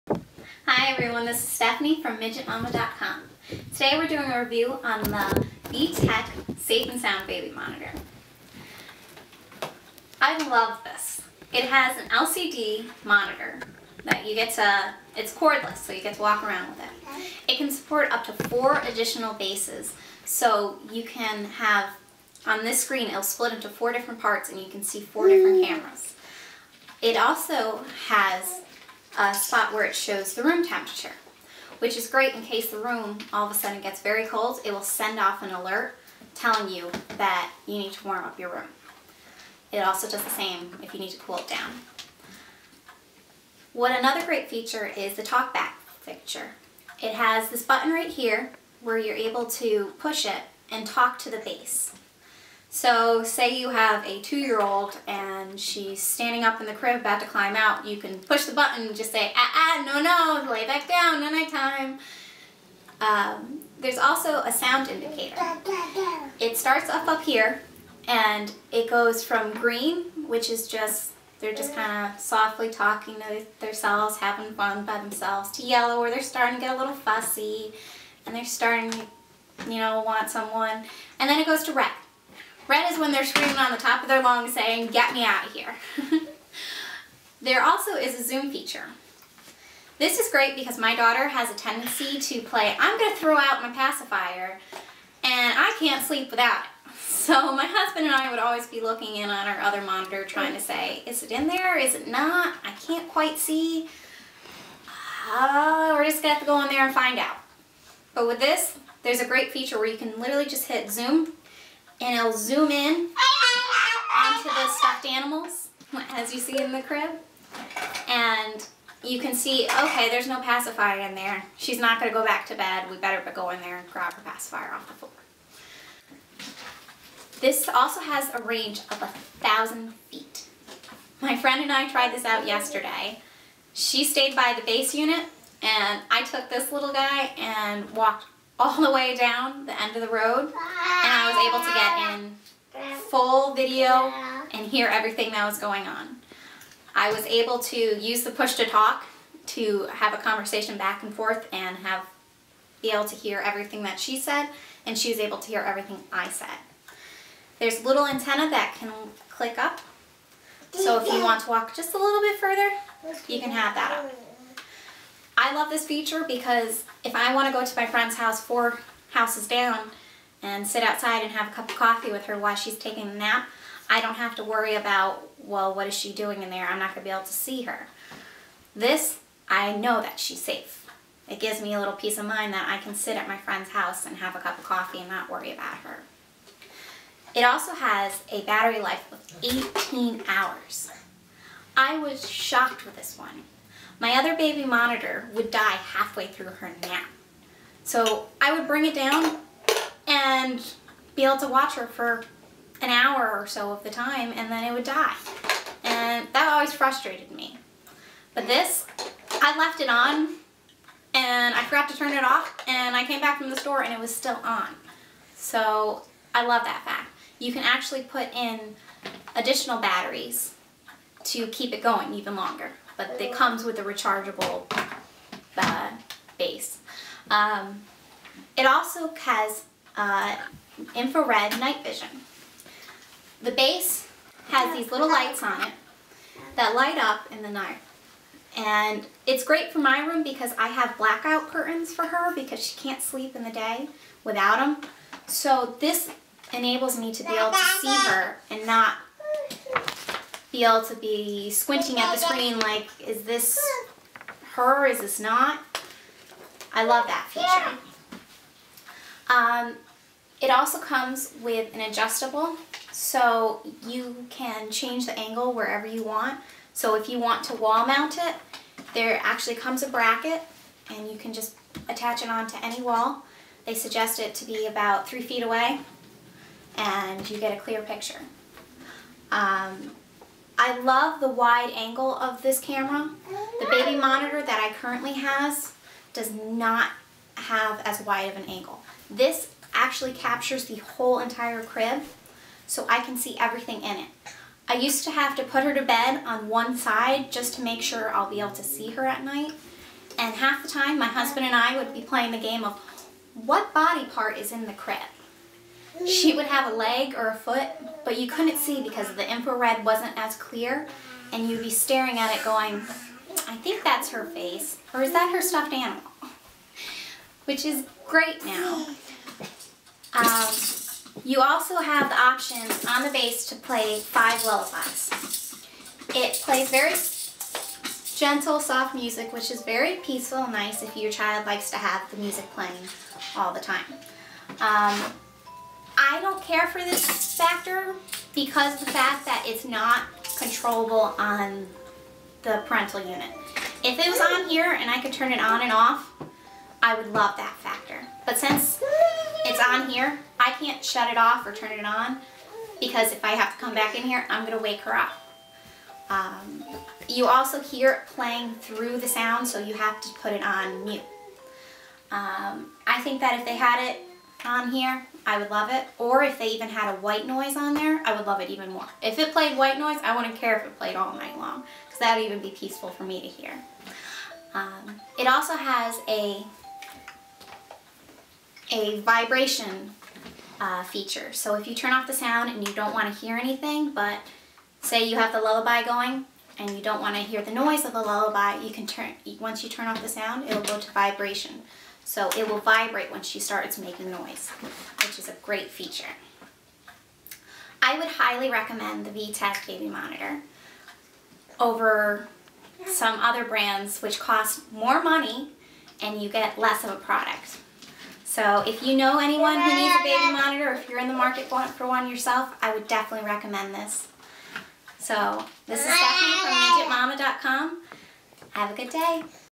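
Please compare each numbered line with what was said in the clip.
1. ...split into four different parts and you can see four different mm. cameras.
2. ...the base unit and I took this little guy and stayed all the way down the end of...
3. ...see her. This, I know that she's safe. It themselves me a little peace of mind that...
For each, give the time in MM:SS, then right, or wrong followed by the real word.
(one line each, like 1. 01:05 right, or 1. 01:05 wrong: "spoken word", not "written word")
1. 00:23 right
2. 02:14 wrong: "walked", not "stayed"
3. 02:57 wrong: "gives", not "themselves".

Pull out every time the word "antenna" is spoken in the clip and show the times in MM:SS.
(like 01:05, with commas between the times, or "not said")
02:38.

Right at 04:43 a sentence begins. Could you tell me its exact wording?
The baby monitor that I currently has does not have as wide of an angle.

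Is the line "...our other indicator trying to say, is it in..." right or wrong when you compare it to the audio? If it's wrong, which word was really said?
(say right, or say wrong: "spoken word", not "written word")
wrong: "monitor", not "indicator".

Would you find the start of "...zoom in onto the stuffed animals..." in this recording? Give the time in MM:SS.
01:52.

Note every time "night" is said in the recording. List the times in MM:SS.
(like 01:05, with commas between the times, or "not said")
01:01, 03:51, 03:57, 04:59, 06:11.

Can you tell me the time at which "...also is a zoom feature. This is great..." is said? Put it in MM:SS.
01:27.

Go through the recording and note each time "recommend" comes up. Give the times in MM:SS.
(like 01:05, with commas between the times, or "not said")
06:38, 06:53.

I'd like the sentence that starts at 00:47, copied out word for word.
It has this button right here where you're able to push it and talk to the base.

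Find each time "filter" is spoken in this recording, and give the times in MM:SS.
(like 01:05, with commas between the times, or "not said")
not said.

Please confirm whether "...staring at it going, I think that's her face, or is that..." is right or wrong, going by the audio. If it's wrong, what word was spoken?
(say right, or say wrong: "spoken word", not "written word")
right.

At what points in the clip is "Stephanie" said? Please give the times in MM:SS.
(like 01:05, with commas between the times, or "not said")
00:01, 06:55.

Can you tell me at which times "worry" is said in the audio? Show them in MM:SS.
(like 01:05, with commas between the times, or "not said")
02:54, 03:05.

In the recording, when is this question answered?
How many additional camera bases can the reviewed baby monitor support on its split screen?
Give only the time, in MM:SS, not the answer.
00:18.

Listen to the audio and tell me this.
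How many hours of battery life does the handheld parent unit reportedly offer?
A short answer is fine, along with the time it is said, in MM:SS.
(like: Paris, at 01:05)
18 hours, at 03:09.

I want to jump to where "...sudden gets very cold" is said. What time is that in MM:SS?
00:33.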